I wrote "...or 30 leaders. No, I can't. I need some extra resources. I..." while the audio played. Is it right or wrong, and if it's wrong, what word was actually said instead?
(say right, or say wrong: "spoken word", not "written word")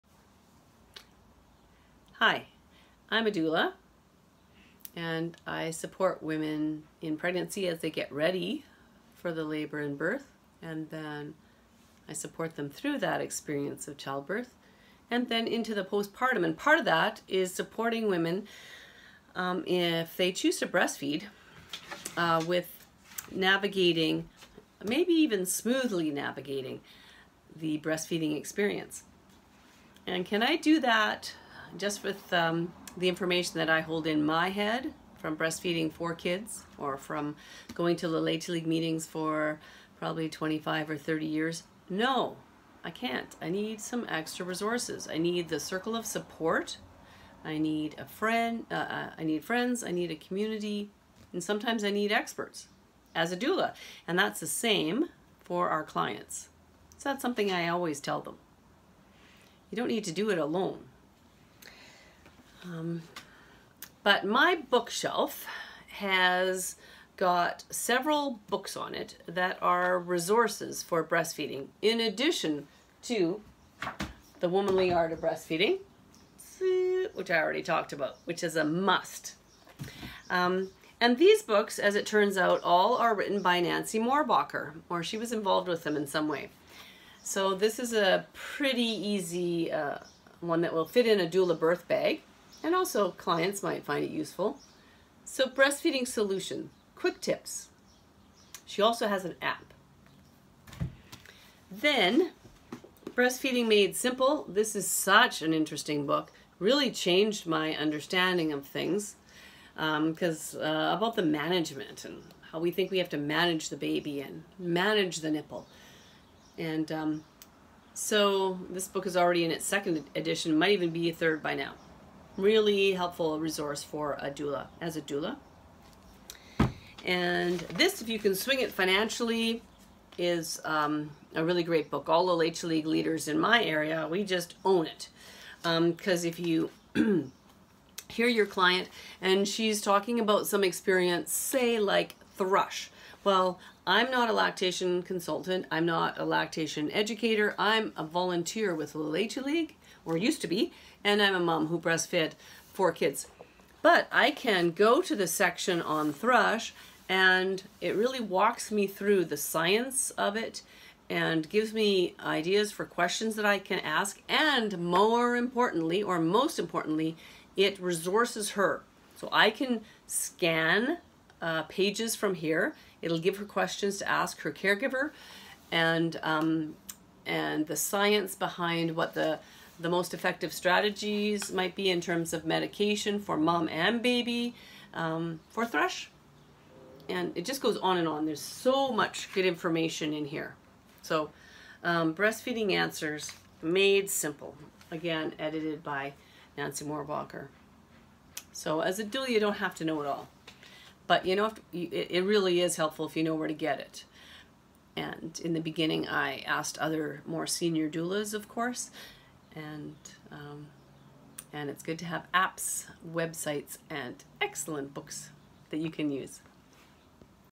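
wrong: "years", not "leaders".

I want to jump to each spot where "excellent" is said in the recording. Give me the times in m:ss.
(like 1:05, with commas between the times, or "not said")
3:34.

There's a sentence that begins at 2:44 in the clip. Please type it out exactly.
And more importantly, or most importantly, it resources her.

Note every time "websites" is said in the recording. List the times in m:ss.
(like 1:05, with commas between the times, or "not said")
3:33.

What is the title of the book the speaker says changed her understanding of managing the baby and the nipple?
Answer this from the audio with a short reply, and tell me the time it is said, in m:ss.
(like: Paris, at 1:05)
Breastfeeding Made Simple, at 1:43.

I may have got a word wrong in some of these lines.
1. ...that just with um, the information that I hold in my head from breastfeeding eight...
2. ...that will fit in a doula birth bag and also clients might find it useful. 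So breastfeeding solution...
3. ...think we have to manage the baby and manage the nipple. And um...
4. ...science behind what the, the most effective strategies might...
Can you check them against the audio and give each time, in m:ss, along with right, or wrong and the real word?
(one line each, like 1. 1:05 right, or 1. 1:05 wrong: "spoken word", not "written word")
1. 0:30 wrong: "four", not "eight"
2. 1:30 right
3. 1:52 right
4. 2:57 right.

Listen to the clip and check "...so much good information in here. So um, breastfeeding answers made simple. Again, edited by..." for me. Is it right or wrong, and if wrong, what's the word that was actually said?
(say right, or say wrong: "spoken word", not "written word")
right.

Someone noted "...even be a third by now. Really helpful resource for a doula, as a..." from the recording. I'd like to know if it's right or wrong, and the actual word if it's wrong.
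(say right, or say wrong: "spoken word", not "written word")
right.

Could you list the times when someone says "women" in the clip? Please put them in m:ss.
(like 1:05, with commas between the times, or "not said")
0:06, 0:18.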